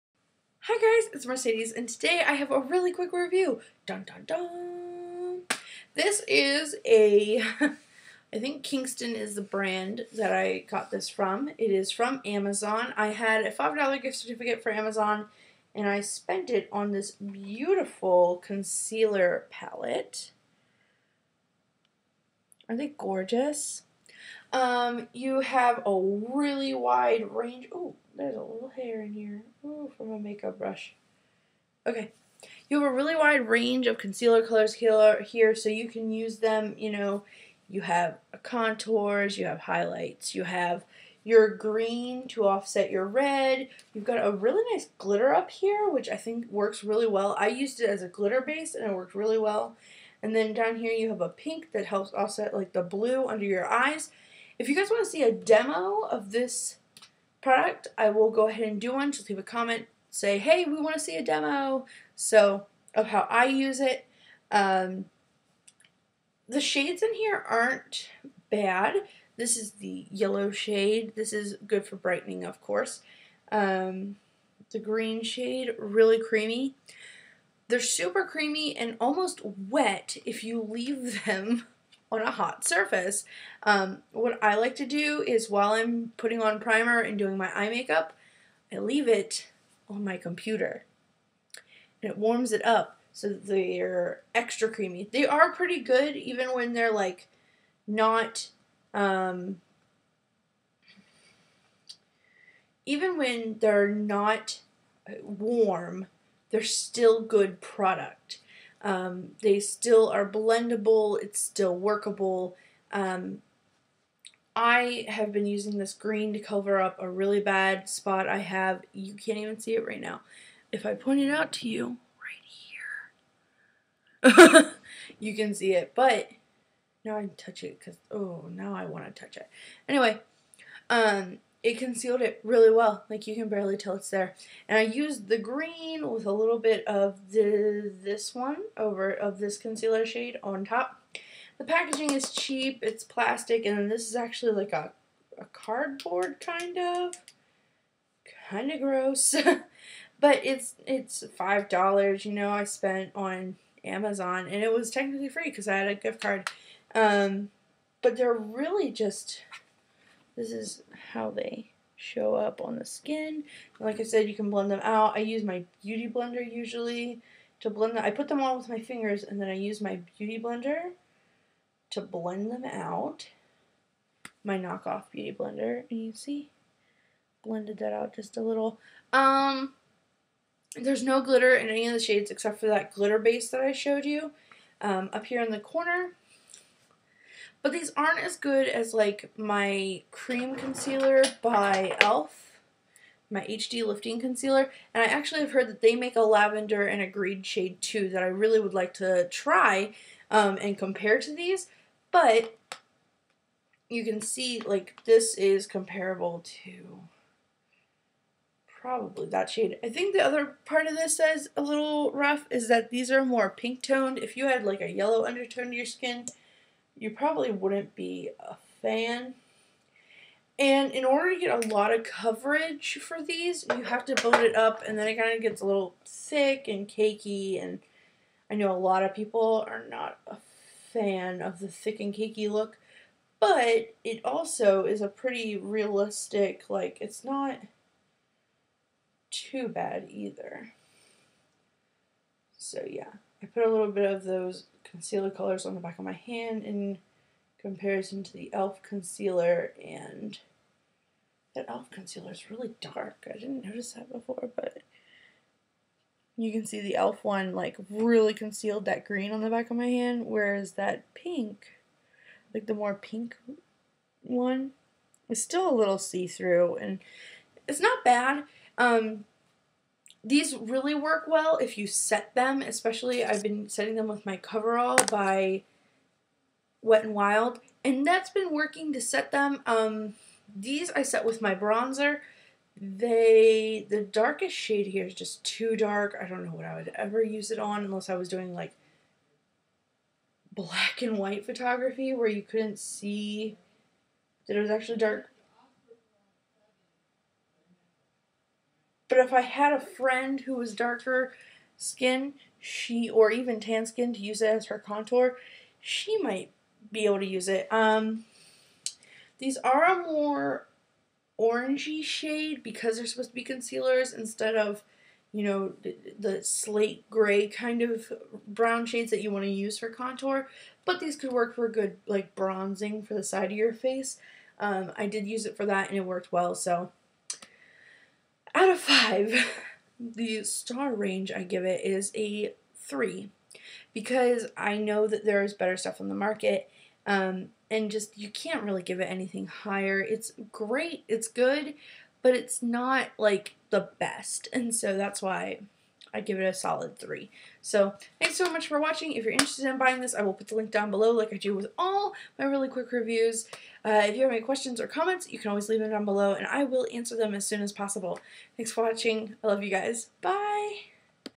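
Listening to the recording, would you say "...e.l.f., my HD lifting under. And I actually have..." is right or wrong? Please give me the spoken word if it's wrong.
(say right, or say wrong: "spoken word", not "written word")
wrong: "concealer", not "under".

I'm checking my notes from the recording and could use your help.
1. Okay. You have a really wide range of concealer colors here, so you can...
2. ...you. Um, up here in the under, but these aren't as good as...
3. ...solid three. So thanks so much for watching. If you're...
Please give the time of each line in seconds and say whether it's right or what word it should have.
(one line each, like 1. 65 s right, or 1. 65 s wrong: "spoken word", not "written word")
1. 31 s right
2. 184 s wrong: "corner", not "under"
3. 346 s right.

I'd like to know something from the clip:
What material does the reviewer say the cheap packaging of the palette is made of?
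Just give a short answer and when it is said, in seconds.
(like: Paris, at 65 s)
Plastic, at 143 s.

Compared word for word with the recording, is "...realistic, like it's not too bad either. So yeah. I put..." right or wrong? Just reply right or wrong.
right.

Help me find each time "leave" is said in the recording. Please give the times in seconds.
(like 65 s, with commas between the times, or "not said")
59 s, 80 s, 88 s, 355 s.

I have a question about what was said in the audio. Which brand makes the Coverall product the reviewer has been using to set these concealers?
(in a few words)
Wet n Wild.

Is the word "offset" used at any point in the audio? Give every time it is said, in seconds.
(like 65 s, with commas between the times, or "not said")
42 s, 52 s.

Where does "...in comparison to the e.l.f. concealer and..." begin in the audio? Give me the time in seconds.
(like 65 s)
246 s.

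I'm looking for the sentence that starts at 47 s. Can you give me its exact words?
I used it as a glitter base, and it worked really well.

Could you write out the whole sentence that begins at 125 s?
But now I touch it because, oh, now I want to touch it.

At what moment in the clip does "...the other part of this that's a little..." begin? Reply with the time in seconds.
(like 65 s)
210 s.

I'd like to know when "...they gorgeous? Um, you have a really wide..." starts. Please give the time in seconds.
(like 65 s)
22 s.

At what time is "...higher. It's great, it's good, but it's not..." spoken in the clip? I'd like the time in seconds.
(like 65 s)
339 s.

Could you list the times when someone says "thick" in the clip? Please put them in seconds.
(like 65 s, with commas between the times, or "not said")
226 s, 231 s.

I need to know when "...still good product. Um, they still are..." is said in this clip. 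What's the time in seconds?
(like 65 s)
106 s.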